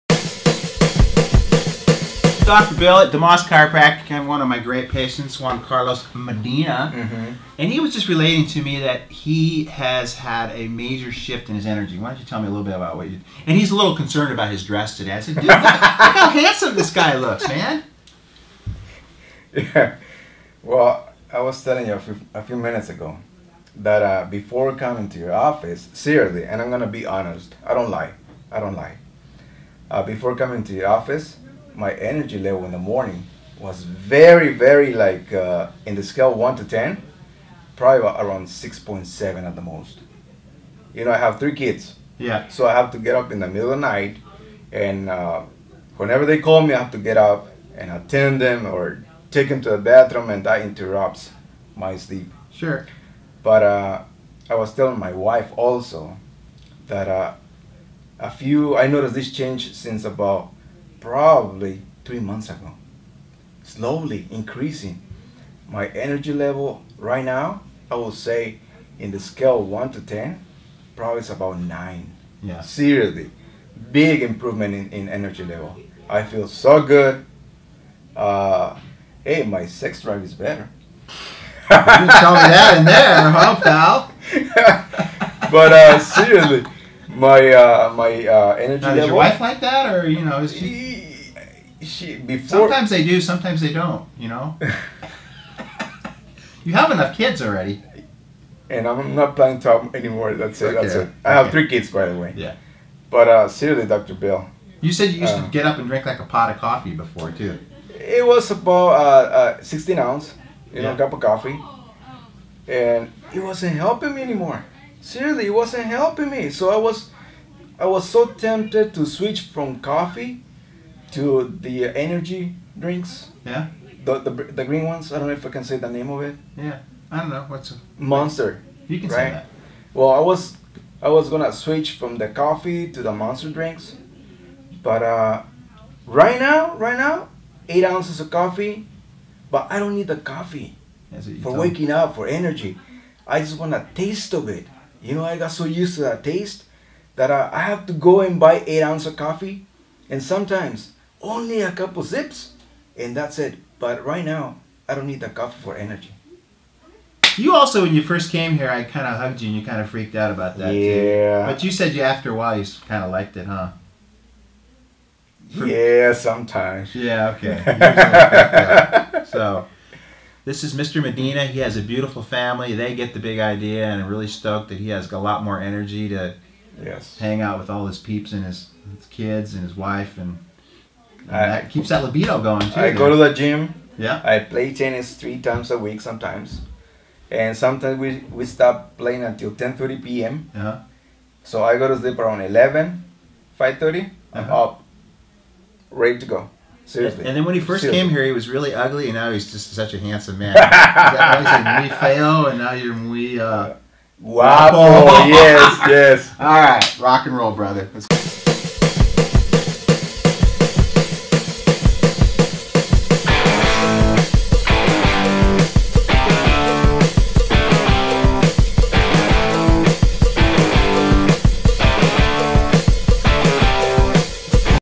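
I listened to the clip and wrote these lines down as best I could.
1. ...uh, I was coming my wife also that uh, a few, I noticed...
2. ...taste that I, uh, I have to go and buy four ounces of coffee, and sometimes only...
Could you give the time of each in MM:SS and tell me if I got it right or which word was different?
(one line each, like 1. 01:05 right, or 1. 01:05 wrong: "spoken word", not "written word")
1. 00:53 wrong: "telling", not "coming"
2. 02:26 wrong: "eight", not "four".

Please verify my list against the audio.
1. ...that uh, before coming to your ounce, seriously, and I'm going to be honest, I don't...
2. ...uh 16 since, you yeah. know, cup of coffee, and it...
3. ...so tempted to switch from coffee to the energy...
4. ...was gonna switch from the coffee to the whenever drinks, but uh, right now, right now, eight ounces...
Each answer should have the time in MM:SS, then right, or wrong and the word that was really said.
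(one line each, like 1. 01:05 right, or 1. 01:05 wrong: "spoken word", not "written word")
1. 00:23 wrong: "office", not "ounce"
2. 01:49 wrong: "ounce", not "since"
3. 01:58 right
4. 02:11 wrong: "monster", not "whenever".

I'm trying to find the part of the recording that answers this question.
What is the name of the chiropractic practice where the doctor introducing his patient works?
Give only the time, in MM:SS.
00:03.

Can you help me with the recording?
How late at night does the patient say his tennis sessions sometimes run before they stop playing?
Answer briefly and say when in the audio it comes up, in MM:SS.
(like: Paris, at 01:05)
10:30 p.m., at 03:09.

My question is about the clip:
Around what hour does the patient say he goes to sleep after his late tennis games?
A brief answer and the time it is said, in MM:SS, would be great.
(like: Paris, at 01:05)
11, at 03:12.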